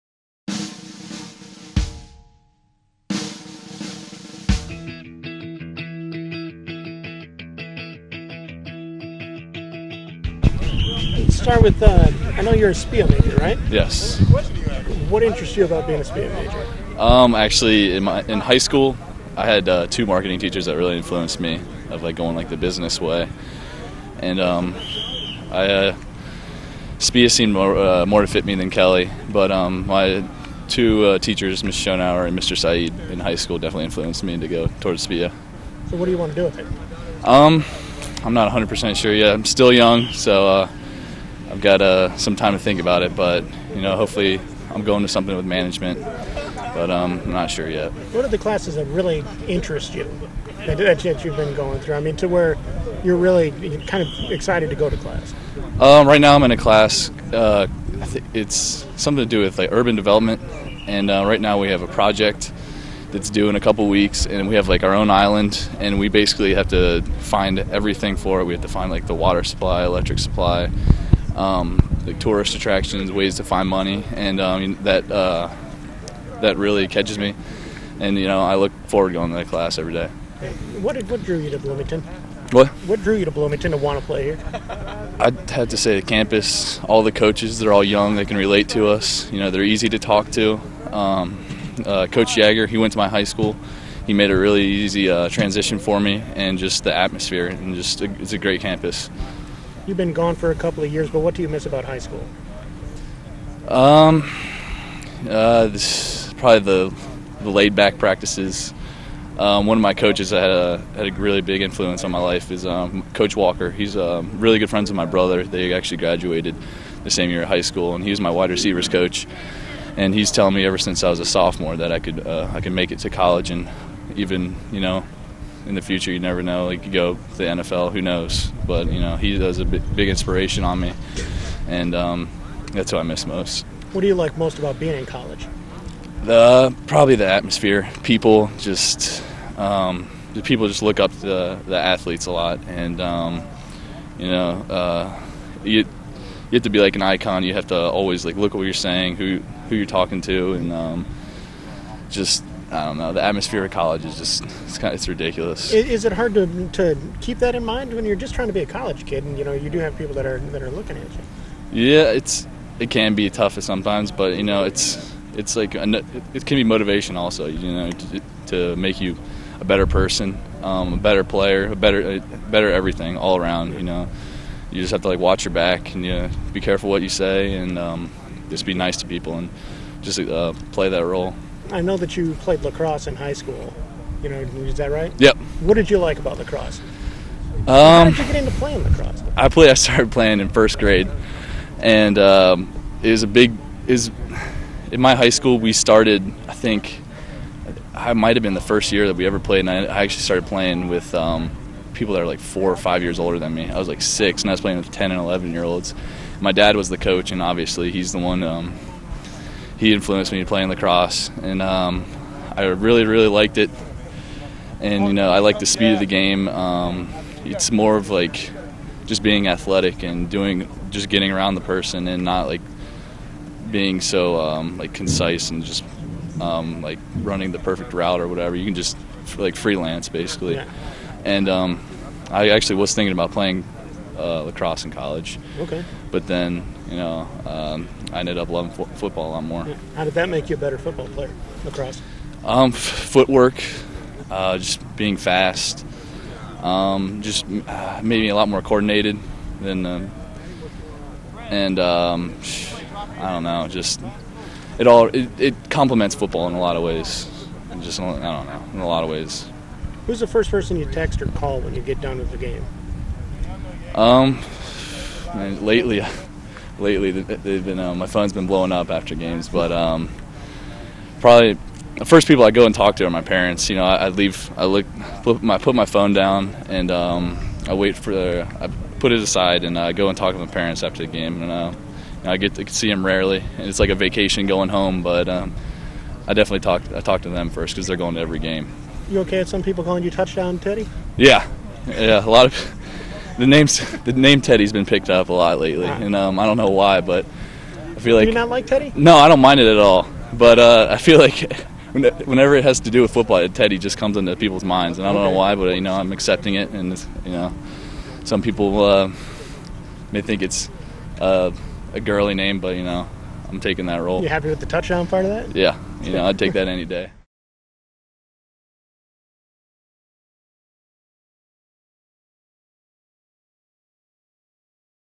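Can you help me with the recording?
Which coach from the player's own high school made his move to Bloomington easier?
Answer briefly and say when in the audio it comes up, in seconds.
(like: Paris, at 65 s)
Coach Jagger, at 92 s.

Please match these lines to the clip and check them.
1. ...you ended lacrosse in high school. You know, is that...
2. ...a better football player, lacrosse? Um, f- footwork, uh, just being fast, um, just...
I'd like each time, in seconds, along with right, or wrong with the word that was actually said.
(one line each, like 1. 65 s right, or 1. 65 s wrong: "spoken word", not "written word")
1. 182 s wrong: "played", not "ended"
2. 240 s right.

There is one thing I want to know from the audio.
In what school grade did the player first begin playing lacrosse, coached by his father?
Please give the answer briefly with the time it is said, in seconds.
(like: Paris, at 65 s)
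First grade, at 190 s.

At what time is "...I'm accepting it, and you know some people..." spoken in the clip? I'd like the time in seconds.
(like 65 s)
305 s.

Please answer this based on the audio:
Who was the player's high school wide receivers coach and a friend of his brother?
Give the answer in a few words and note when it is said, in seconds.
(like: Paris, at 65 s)
Coach Walker, at 113 s.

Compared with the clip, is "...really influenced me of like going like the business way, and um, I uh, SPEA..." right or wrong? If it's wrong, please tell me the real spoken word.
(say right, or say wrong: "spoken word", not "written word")
right.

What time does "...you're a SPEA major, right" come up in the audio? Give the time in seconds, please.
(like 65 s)
12 s.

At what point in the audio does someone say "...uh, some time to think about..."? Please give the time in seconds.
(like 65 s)
41 s.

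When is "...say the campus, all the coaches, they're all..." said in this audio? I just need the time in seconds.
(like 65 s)
85 s.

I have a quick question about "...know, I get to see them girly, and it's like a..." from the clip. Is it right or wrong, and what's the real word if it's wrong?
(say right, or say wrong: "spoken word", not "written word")
wrong: "rarely", not "girly".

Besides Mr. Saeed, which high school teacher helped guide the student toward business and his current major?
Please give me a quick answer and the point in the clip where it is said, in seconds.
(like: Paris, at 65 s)
Ms. Schoenauer, at 31 s.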